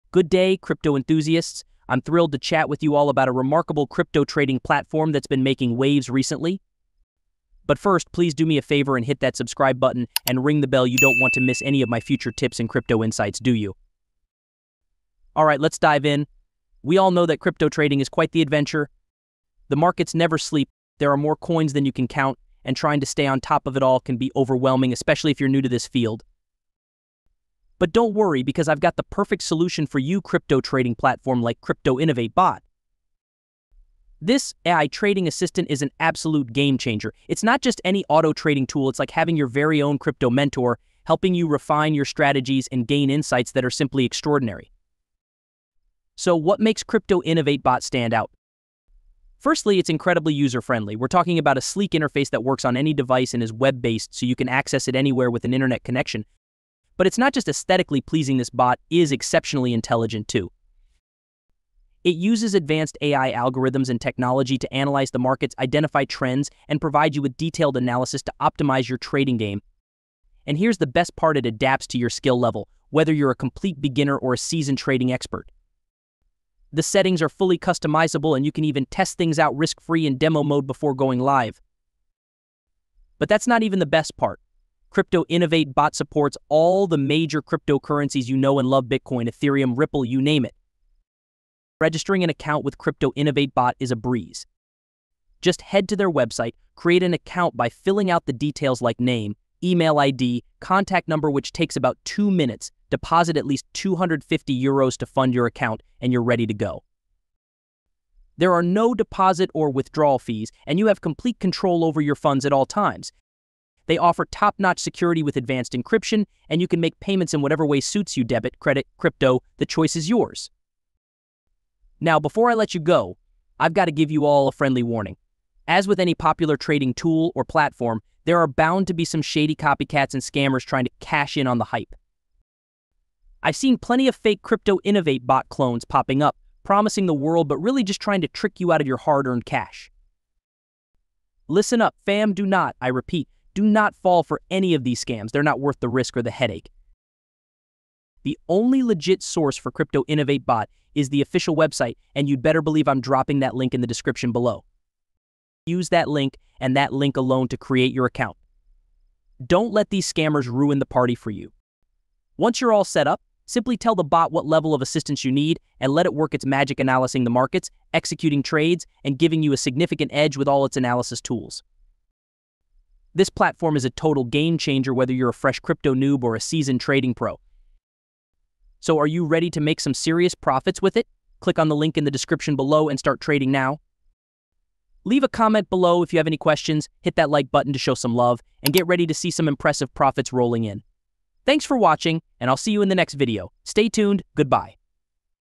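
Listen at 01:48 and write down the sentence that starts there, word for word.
There are no deposit or withdrawal fees, and you have complete control over your funds at all times.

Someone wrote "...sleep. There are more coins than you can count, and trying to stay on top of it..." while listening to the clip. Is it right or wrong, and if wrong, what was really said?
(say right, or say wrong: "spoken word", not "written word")
right.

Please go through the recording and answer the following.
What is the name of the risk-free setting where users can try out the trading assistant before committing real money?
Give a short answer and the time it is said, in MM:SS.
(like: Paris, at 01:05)
demo mode, at 01:20.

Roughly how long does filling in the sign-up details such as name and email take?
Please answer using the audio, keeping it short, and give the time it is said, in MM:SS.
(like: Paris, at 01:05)
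two minutes, at 01:42.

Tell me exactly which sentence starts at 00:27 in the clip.
But don't worry because I've got the perfect solution for you crypto trading platform like Crypto Innovate Bot.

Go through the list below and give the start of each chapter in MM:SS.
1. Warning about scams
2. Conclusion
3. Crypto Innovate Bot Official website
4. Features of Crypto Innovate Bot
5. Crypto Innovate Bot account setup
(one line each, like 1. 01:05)
1. 02:00
2. 02:57
3. 02:30
4. 01:01
5. 01:31.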